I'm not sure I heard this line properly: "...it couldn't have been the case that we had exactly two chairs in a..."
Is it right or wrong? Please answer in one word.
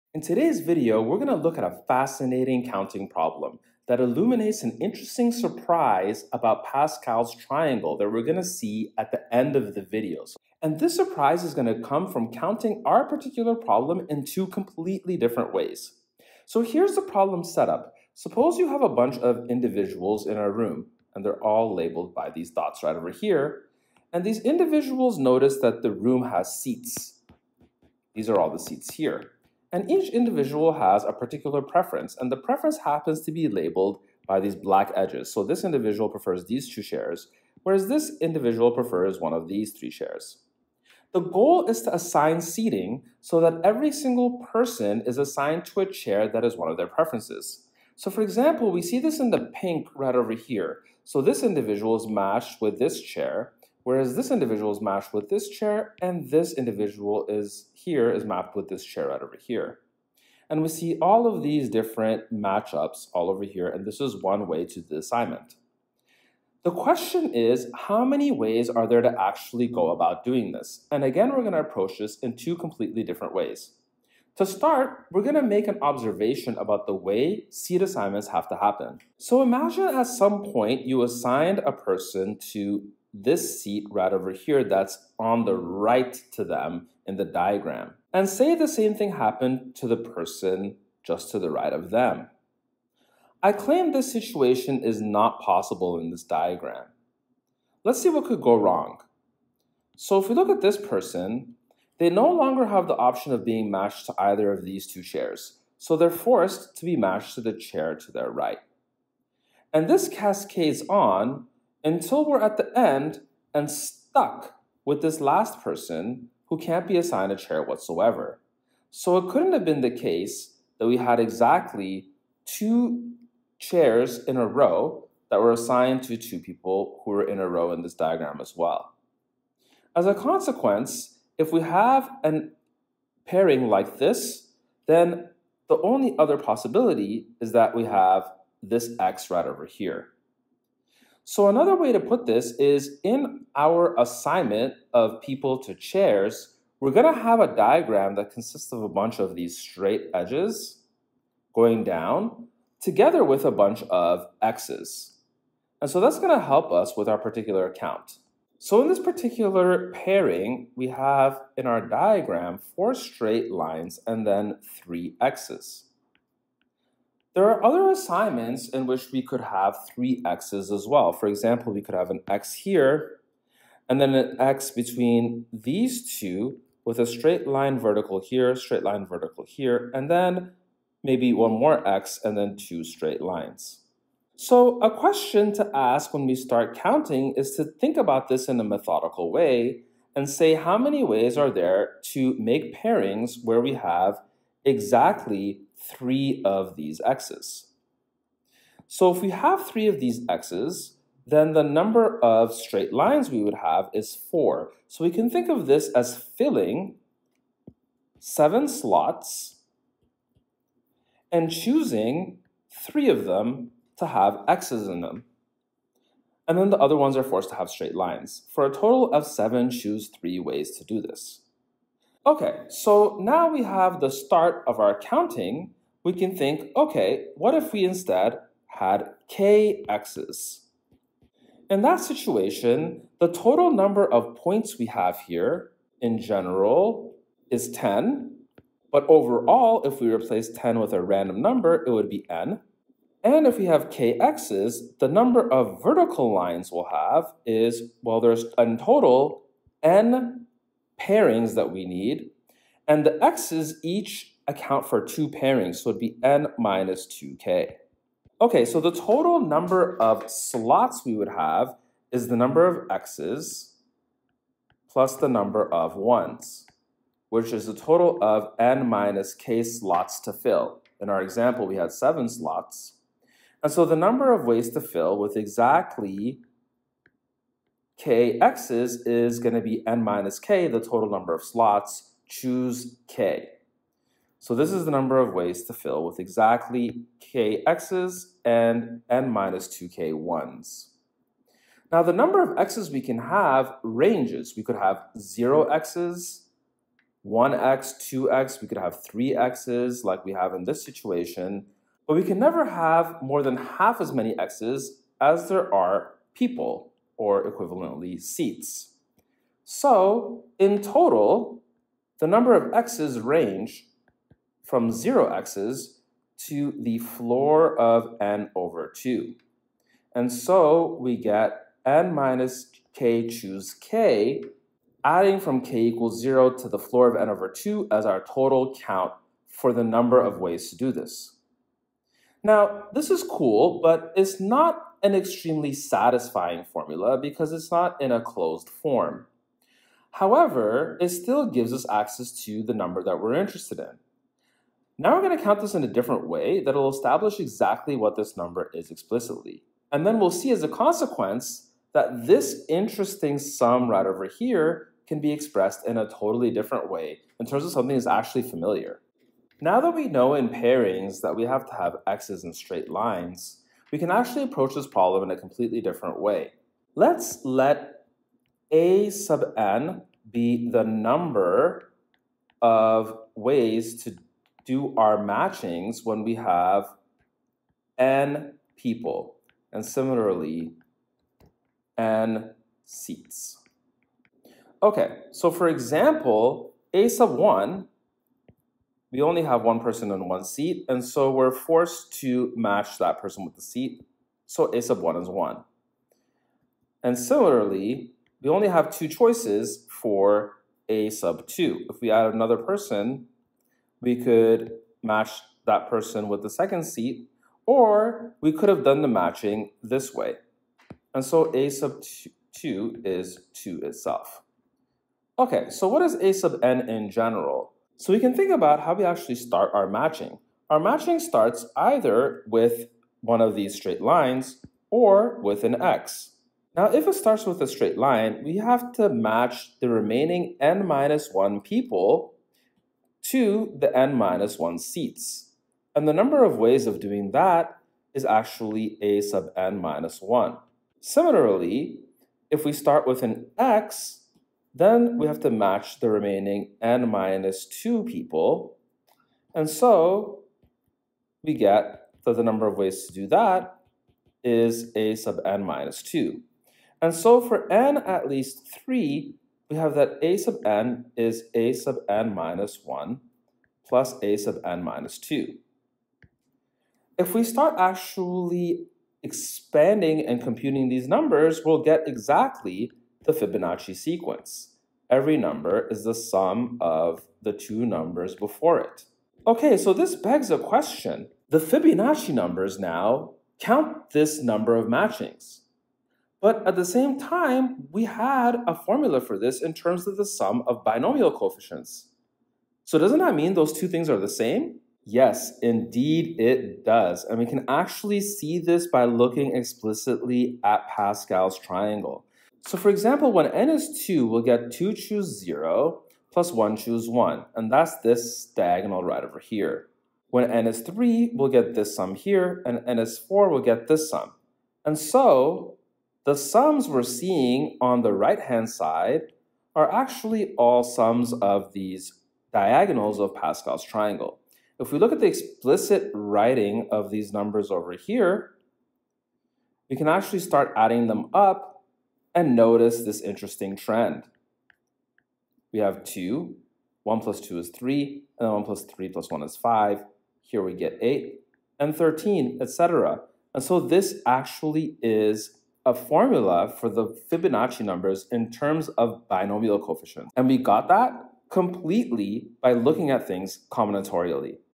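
right.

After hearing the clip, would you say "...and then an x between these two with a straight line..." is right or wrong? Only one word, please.
right.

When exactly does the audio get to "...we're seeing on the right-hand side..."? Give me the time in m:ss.
8:36.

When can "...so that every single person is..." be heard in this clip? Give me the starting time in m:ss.
0:43.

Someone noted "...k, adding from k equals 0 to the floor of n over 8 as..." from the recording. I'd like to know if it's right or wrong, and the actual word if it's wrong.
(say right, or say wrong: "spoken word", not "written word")
wrong: "2", not "8".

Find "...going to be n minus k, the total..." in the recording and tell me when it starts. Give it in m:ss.
4:39.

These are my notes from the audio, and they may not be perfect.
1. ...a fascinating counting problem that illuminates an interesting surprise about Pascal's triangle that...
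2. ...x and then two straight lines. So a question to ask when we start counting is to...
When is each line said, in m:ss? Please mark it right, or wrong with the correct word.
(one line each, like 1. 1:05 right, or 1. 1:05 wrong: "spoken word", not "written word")
1. 0:01 right
2. 3:01 right.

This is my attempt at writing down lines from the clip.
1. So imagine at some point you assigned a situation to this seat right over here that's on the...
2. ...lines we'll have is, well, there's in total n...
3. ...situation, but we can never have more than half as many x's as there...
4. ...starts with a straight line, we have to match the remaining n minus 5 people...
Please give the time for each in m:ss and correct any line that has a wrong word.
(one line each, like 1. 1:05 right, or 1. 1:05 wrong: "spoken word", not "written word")
1. 1:19 wrong: "person", not "situation"
2. 4:06 right
3. 5:00 right
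4. 7:07 wrong: "1", not "5".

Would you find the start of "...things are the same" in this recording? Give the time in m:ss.
8:13.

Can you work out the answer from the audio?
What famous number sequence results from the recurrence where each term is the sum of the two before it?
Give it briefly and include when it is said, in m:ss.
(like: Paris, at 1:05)
Fibonacci sequence, at 7:53.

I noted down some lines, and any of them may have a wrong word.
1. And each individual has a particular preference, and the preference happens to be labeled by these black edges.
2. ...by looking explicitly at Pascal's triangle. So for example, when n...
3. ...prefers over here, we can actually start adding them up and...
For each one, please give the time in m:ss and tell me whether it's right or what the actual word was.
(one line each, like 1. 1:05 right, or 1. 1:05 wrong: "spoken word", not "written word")
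1. 0:29 right
2. 8:18 right
3. 8:47 wrong: "numbers", not "prefers".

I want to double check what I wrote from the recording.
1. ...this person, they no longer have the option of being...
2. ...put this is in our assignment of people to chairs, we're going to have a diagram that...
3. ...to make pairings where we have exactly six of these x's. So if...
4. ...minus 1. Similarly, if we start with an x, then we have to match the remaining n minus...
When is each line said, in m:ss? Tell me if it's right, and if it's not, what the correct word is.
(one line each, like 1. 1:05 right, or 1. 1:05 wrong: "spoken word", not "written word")
1. 1:40 right
2. 2:21 right
3. 3:12 wrong: "three", not "six"
4. 7:19 right.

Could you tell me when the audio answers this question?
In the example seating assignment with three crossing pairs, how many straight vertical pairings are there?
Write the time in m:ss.
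2:42.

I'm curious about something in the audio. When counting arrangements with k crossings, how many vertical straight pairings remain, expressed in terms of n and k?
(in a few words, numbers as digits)
n minus 2k.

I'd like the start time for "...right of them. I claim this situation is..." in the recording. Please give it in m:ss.
1:31.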